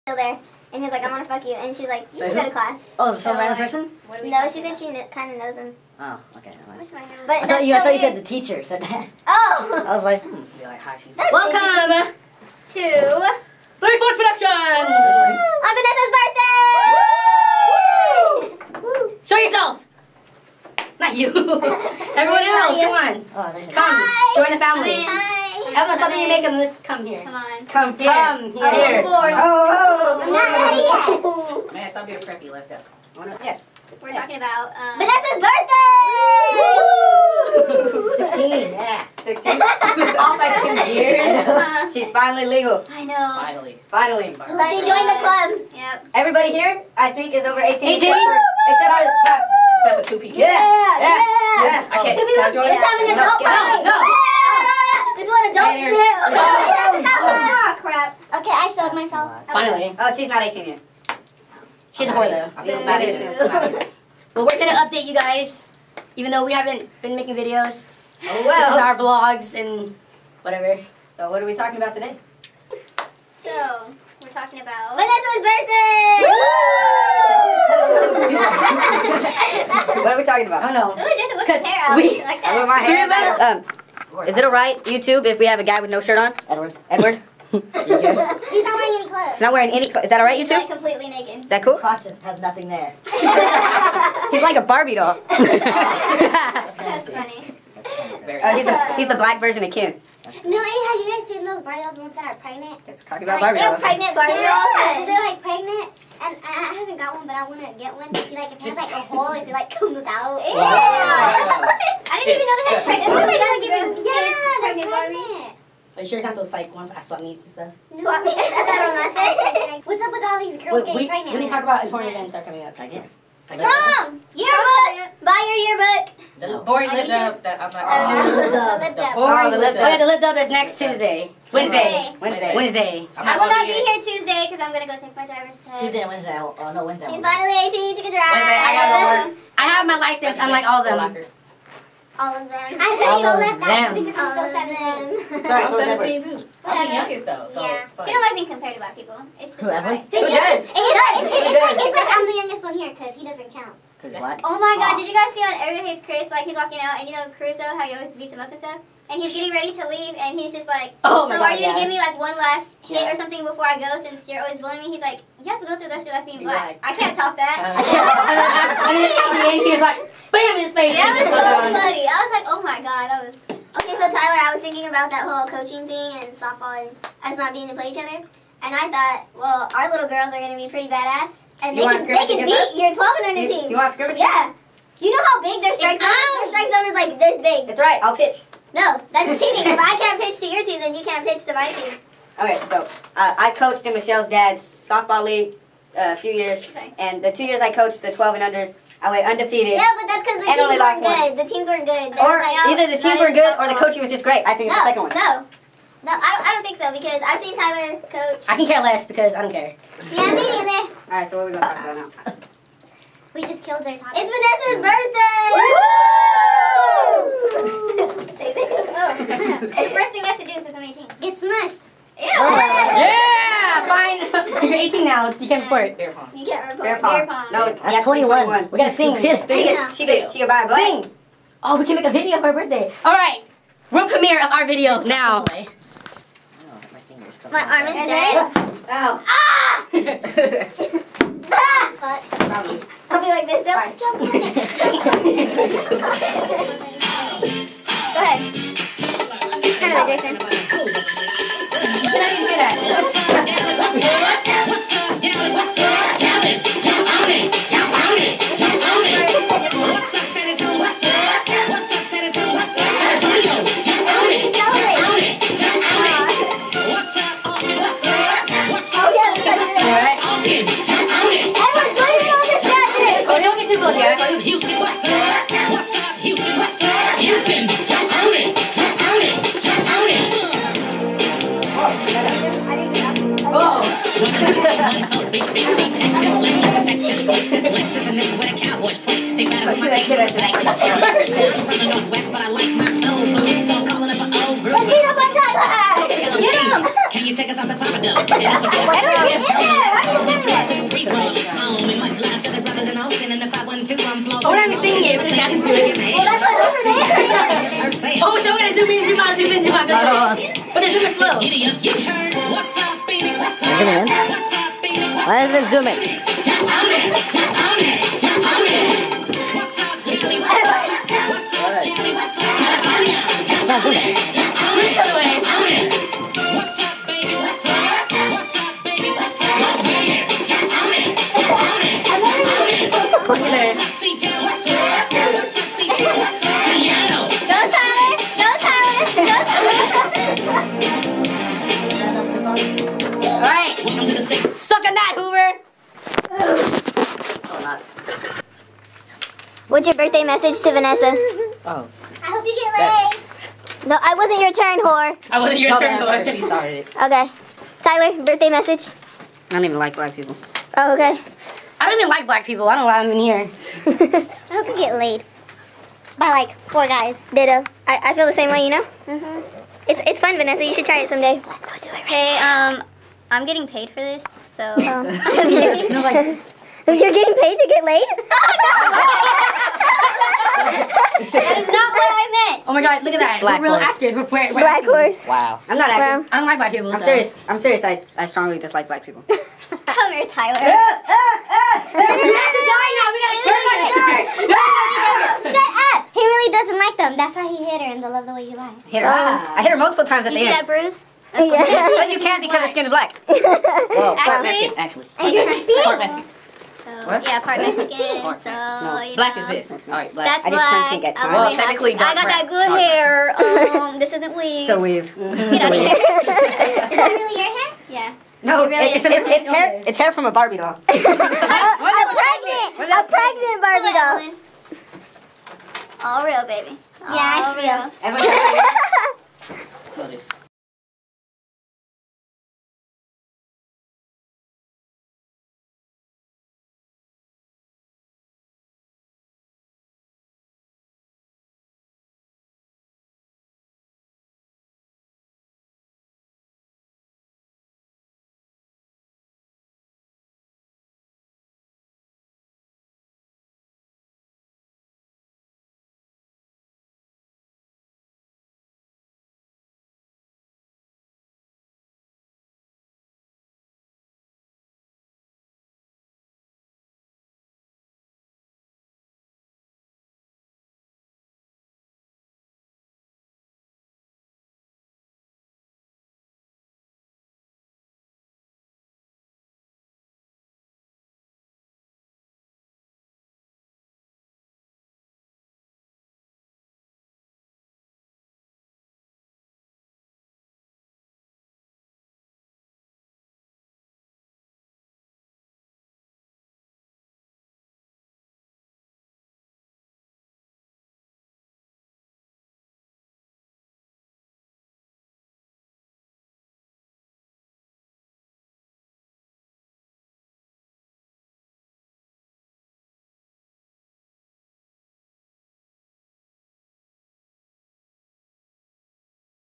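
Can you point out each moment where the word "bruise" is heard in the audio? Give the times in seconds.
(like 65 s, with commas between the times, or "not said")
400 s.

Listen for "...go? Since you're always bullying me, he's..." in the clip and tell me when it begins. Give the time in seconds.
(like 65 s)
163 s.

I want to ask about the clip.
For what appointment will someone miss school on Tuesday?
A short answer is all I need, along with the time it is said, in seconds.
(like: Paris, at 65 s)
Driver's test, at 135 s.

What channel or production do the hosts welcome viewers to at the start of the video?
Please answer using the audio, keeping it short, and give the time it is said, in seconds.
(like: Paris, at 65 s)
Three Fourths Production, at 12 s.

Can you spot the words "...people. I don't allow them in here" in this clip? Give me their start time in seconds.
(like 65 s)
362 s.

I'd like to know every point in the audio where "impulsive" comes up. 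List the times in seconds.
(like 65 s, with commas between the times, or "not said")
not said.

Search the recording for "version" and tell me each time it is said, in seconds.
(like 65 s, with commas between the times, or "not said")
99 s.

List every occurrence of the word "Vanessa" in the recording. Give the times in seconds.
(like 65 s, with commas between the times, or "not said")
18 s, 34 s, 74 s, 214 s, 370 s.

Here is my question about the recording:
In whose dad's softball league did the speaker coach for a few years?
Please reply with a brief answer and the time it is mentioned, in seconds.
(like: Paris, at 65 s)
Michelle's, at 193 s.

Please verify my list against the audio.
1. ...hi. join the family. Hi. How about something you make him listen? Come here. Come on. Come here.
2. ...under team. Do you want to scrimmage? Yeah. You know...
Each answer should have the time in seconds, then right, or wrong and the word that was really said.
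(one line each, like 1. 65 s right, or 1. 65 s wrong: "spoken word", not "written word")
1. 23 s right
2. 183 s right.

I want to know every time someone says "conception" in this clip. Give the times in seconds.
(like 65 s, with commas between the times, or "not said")
not said.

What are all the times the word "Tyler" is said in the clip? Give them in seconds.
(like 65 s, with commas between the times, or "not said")
174 s, 207 s, 357 s, 390 s.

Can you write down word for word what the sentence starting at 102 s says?
Yes, we're talking about like, Barbie dolls.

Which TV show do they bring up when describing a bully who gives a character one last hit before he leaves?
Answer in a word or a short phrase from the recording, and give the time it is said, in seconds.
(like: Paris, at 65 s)
Everything Hates Chris, at 155 s.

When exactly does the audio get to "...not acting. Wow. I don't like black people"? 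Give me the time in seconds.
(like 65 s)
385 s.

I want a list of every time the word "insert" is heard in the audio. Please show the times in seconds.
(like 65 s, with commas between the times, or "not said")
not said.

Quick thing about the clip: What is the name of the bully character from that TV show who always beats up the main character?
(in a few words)
Caruso.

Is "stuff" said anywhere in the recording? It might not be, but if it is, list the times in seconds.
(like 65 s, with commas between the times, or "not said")
117 s, 158 s.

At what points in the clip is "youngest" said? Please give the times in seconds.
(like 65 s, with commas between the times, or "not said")
146 s, 152 s.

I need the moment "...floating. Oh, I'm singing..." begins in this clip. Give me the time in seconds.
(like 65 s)
304 s.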